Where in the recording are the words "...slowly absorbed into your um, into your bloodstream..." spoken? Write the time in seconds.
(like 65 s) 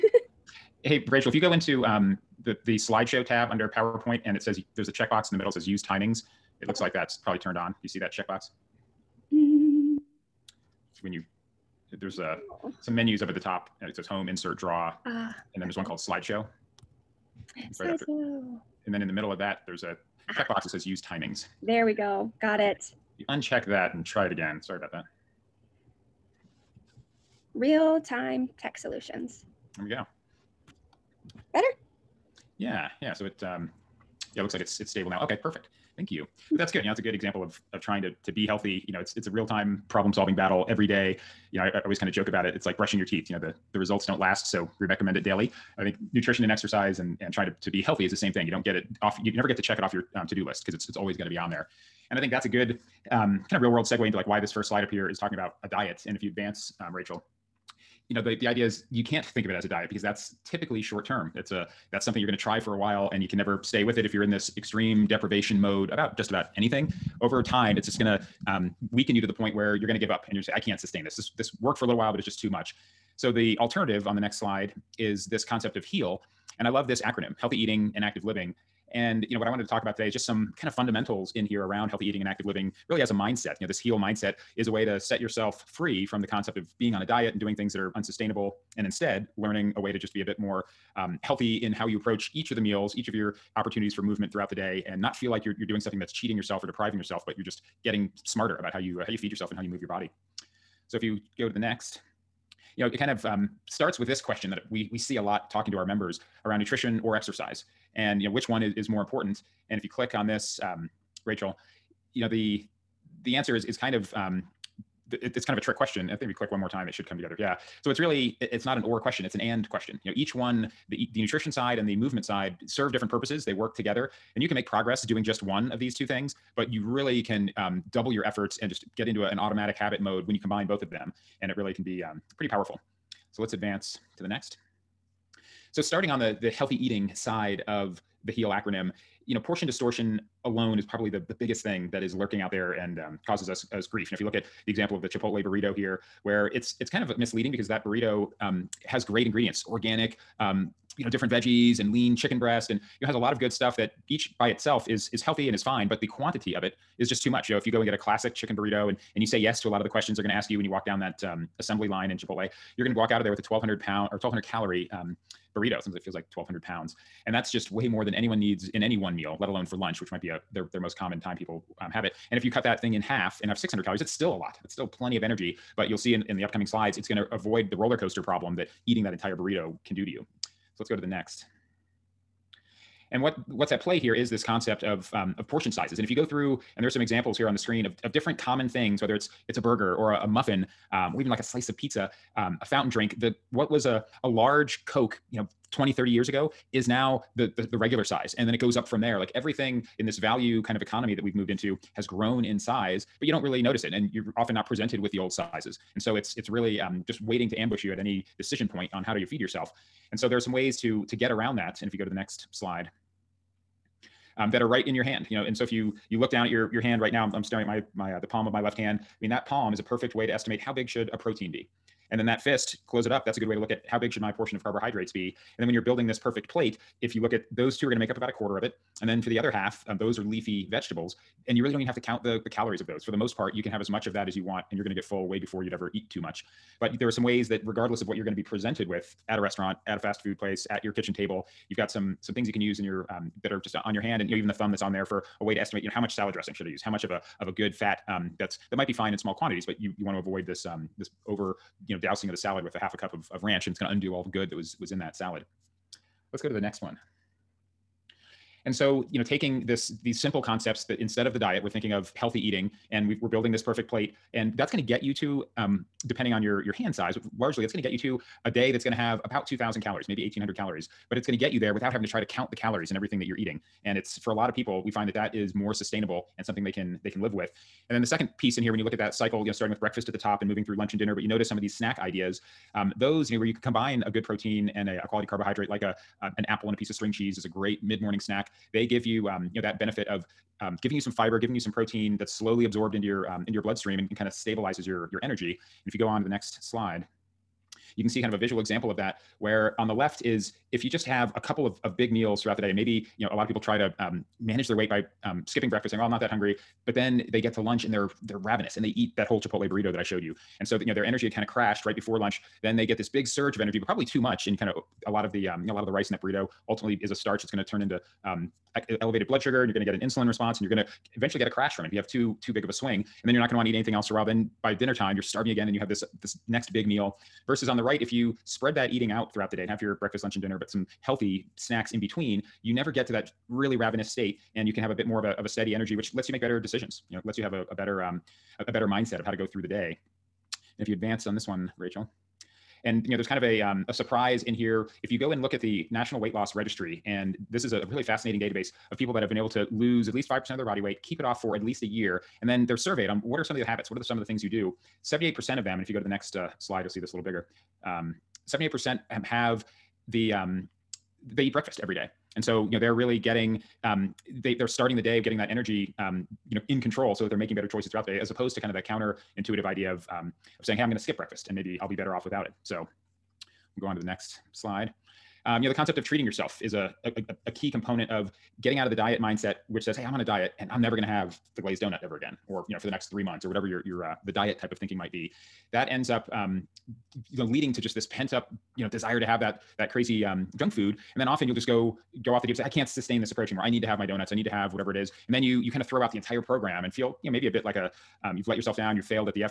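292 s.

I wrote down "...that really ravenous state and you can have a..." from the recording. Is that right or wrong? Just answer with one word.
right.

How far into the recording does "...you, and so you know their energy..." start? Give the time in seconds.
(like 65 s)
310 s.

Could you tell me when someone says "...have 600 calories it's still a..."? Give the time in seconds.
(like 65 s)
173 s.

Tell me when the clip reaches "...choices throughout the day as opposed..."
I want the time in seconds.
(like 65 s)
367 s.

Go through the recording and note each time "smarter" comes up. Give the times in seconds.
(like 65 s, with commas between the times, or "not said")
98 s.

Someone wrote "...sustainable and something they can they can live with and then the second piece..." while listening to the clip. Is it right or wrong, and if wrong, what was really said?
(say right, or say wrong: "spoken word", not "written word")
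right.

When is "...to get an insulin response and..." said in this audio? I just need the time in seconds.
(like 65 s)
319 s.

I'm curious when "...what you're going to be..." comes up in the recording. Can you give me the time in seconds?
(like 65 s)
238 s.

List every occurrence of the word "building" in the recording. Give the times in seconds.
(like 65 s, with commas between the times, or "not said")
225 s, 263 s.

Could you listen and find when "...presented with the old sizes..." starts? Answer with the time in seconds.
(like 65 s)
204 s.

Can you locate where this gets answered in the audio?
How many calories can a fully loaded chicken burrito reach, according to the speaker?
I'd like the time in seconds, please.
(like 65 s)
164 s.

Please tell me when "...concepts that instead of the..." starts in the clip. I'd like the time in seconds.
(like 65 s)
260 s.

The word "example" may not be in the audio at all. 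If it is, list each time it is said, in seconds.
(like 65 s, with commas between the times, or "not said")
37 s, 144 s, 186 s, 298 s.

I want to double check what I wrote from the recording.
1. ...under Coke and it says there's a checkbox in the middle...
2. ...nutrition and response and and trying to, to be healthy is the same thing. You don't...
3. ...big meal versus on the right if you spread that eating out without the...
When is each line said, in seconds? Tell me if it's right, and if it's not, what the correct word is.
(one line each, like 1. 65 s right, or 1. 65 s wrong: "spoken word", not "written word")
1. 3 s wrong: "PowerPoint", not "Coke"
2. 46 s wrong: "exercise", not "response"
3. 326 s wrong: "throughout", not "without".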